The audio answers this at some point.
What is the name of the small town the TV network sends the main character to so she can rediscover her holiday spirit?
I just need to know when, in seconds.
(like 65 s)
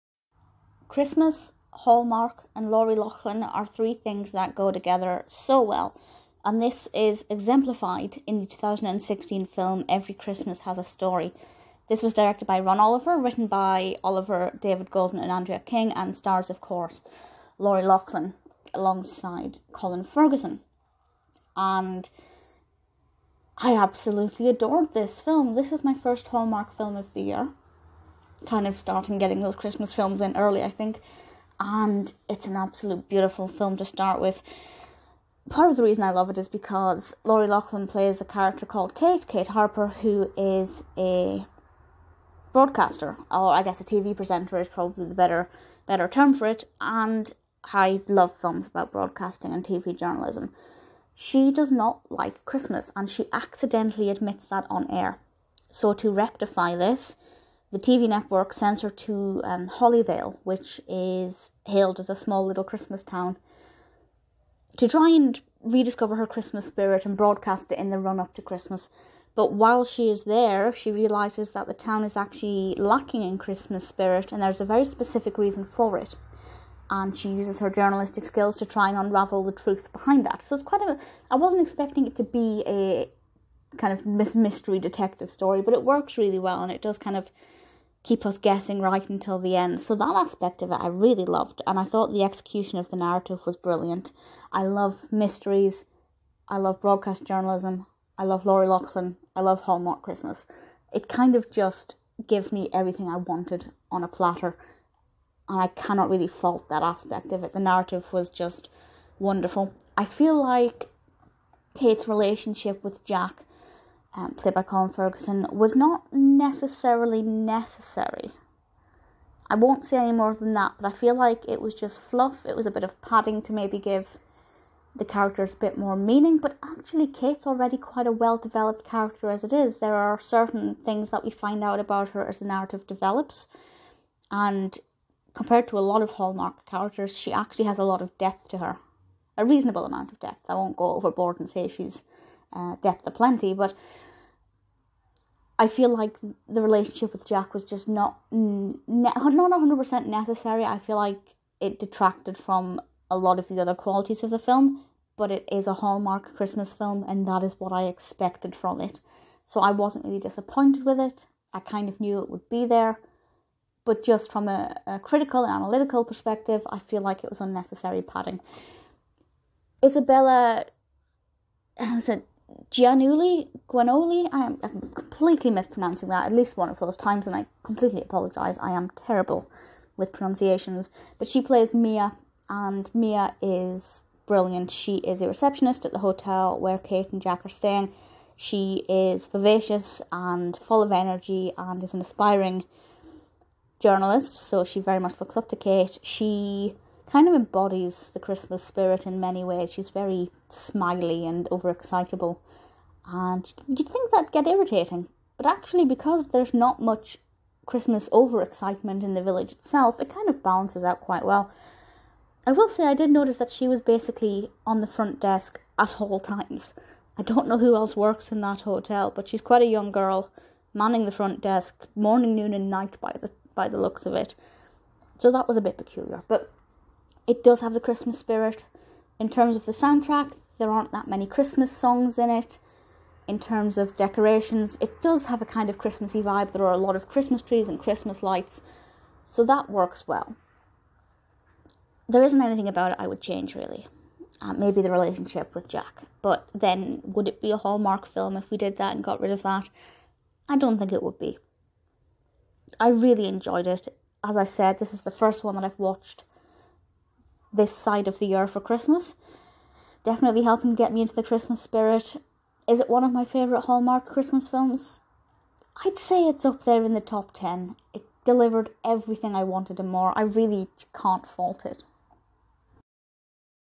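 59 s.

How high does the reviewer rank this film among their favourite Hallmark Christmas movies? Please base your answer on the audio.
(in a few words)
top 10.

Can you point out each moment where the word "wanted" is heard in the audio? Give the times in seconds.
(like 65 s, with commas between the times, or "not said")
103 s, 269 s.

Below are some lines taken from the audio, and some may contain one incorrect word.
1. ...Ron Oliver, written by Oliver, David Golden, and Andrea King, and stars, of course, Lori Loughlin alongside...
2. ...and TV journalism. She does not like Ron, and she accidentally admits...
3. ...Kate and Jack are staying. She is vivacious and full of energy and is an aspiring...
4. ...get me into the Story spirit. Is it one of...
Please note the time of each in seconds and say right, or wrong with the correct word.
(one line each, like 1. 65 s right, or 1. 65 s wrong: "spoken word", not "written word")
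1. 12 s right
2. 49 s wrong: "Christmas", not "Ron"
3. 186 s right
4. 260 s wrong: "Christmas", not "Story".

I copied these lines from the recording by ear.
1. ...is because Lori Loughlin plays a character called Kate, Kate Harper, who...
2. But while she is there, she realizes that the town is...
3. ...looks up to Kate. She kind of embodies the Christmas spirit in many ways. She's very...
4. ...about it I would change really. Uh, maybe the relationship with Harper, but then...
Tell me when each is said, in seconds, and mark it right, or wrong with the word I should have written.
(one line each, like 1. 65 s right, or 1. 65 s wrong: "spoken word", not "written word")
1. 36 s right
2. 69 s right
3. 195 s right
4. 242 s wrong: "Jack", not "Harper".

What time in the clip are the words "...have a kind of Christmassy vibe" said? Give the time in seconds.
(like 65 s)
235 s.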